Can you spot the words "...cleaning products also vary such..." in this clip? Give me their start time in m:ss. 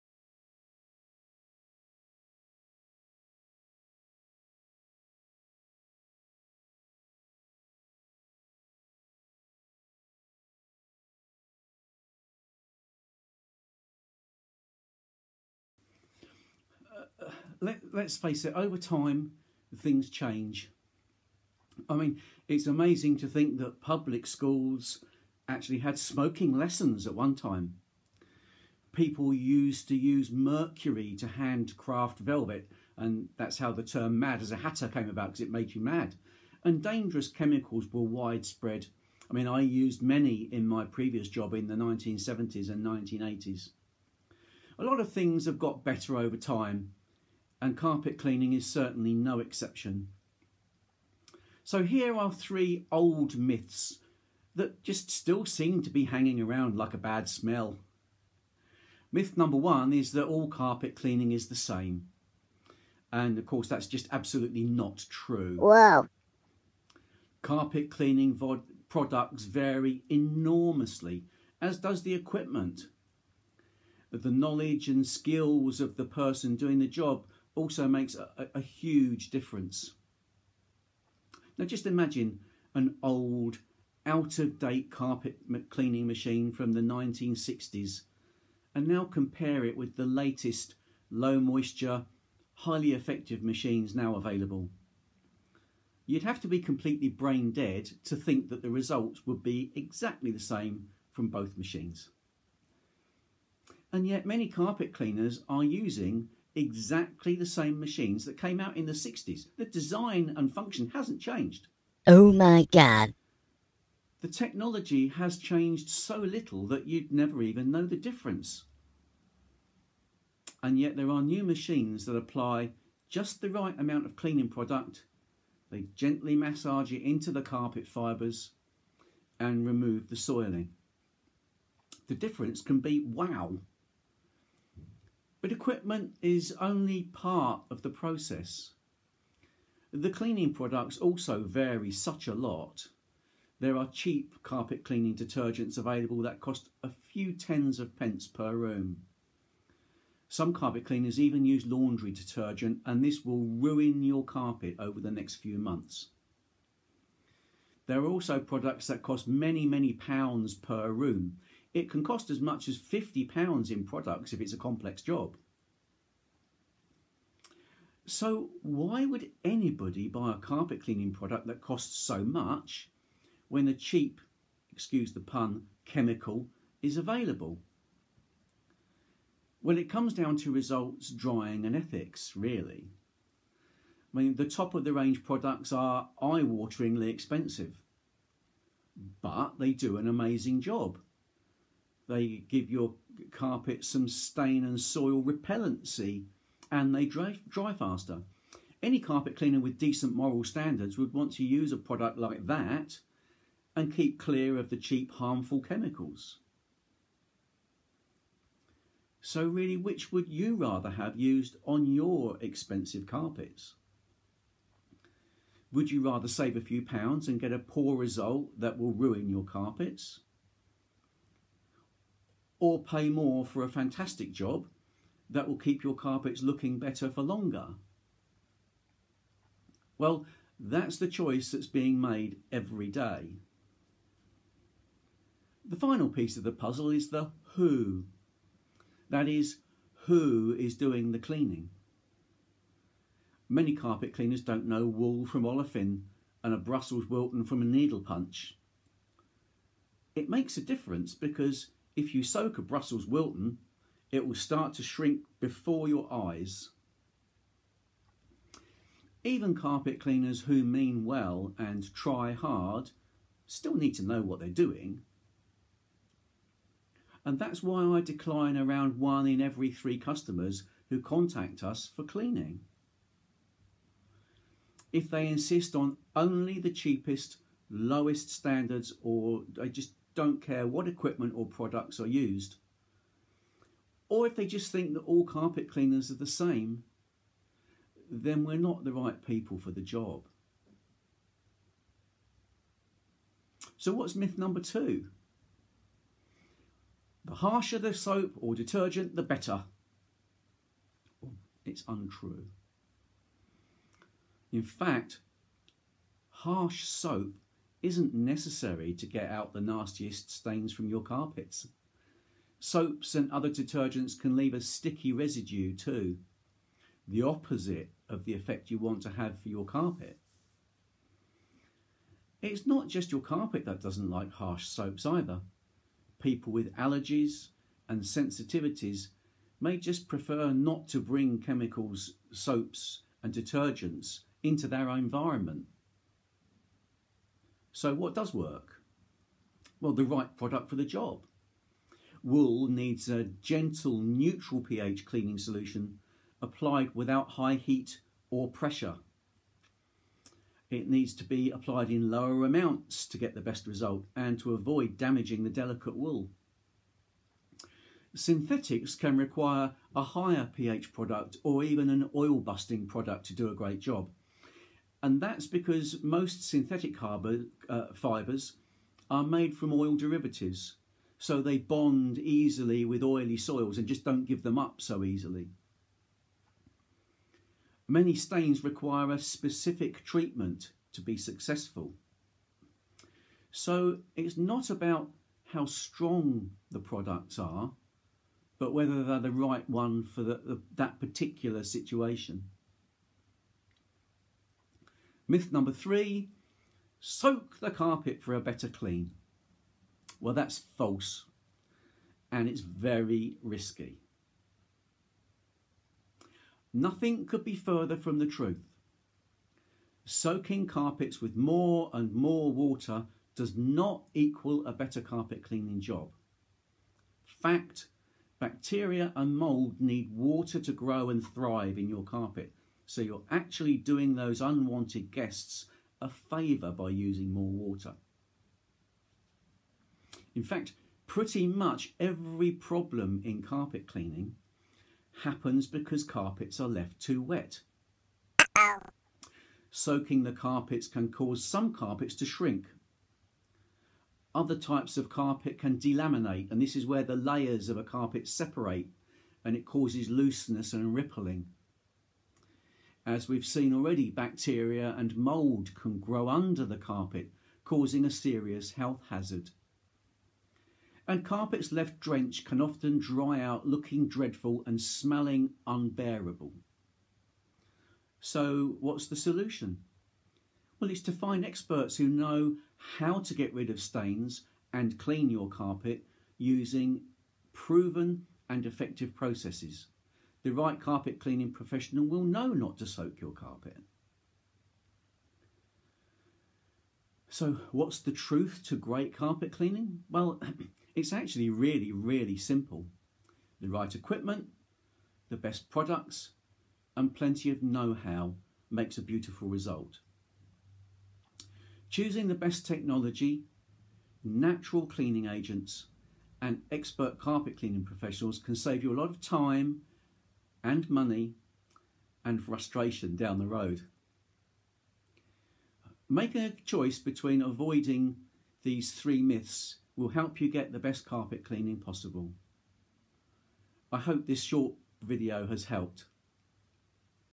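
2:20.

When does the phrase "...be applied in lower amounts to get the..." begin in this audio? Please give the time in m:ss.
5:51.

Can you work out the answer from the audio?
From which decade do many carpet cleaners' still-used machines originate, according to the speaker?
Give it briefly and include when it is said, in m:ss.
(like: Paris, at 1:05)
1960s, at 1:26.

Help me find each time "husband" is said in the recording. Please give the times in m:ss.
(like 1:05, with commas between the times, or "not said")
not said.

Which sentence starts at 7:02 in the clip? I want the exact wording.
So you're actually doing those unwanted guests a favour by using more water.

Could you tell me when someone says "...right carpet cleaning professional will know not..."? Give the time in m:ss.
8:00.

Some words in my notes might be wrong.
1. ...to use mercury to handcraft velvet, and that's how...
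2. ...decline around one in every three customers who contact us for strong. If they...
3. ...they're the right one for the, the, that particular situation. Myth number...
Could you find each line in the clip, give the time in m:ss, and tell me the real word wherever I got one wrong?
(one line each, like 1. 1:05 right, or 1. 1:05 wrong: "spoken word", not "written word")
1. 0:29 right
2. 4:28 wrong: "cleaning", not "strong"
3. 6:29 right.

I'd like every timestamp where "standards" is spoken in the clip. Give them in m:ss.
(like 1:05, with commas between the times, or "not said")
3:20, 4:38.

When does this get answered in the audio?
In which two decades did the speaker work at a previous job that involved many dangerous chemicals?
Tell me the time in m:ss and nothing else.
0:41.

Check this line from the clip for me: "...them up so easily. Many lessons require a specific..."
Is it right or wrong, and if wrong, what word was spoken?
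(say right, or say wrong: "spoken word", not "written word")
wrong: "stains", not "lessons".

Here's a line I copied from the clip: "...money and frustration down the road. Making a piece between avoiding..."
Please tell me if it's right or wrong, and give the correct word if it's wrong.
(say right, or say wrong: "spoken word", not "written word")
wrong: "choice", not "piece".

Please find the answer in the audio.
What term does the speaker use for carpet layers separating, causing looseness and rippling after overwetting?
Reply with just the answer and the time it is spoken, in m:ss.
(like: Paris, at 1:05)
delaminate, at 7:25.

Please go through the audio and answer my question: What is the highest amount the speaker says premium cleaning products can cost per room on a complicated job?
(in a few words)
£50.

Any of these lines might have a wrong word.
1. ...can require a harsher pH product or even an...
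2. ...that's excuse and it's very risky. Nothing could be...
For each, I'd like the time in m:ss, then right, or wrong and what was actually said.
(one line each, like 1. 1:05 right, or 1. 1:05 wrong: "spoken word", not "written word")
1. 5:58 wrong: "higher", not "harsher"
2. 6:40 wrong: "false", not "excuse".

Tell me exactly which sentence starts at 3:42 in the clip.
or pay more for a fantastic job that will keep your carpets looking better for longer?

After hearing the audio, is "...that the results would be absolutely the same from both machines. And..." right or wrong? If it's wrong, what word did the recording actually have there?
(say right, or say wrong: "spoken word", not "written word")
wrong: "exactly", not "absolutely".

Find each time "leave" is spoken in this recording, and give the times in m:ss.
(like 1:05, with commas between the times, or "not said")
5:14.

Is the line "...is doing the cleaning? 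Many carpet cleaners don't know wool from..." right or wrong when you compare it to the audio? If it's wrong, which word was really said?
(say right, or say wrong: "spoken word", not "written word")
right.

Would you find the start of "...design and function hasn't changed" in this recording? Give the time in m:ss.
1:49.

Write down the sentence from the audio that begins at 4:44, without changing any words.
Or if they just think that all carpet cleaners are the same, then we're not the right people for the job.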